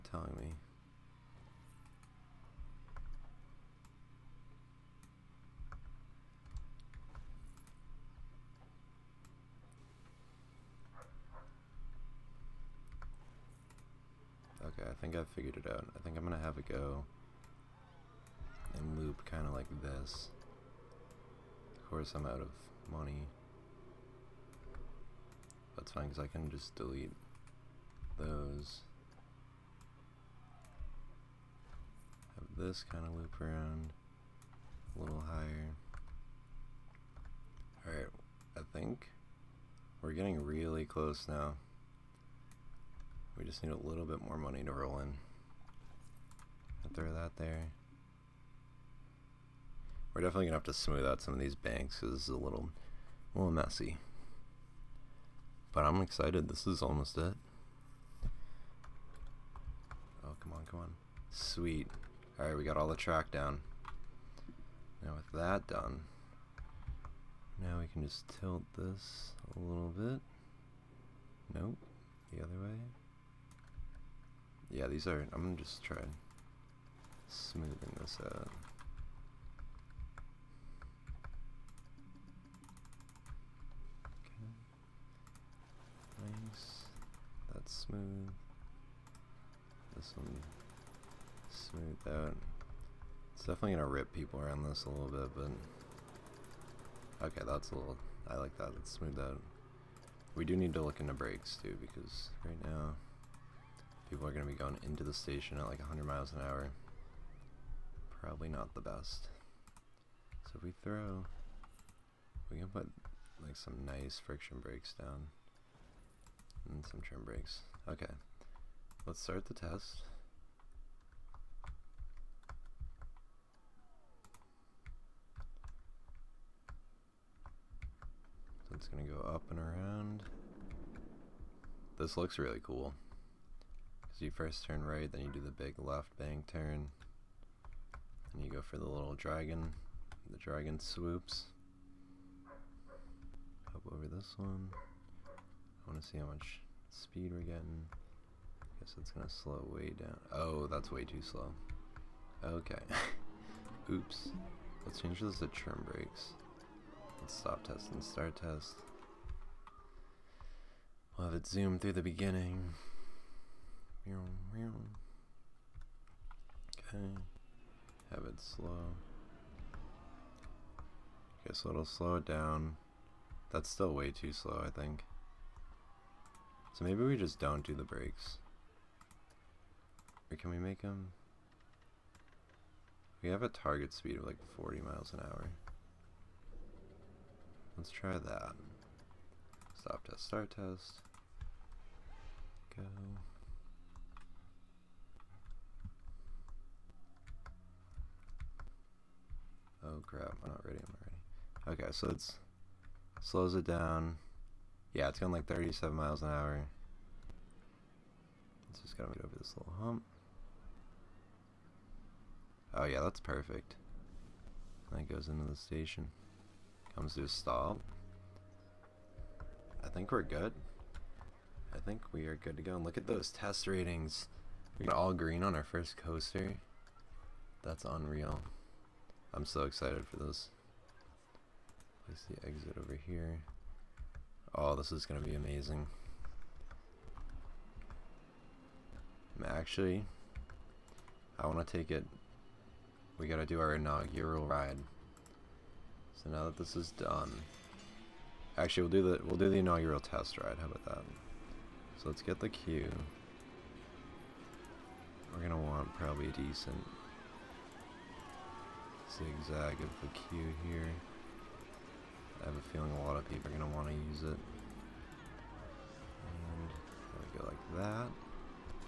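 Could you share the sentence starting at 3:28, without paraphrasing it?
It's just gotta get over this little hump.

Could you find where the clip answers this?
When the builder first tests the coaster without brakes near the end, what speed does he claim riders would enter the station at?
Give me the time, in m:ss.
1:45.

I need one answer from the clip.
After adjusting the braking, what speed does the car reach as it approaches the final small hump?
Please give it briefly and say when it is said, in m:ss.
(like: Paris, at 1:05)
37 miles an hour, at 3:25.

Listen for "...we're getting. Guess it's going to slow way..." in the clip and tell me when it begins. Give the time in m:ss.
2:27.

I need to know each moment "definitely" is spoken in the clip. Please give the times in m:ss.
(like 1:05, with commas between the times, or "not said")
0:50, 1:33.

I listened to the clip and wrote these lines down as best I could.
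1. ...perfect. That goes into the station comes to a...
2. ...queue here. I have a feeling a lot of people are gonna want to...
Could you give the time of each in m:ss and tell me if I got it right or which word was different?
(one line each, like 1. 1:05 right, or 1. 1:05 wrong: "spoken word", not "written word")
1. 3:33 right
2. 4:20 right.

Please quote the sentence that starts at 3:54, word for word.
Oh, this is going to be amazing.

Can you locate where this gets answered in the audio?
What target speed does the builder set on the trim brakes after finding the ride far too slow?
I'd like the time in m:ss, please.
3:04.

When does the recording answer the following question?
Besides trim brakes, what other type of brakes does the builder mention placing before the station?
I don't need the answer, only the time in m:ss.
1:54.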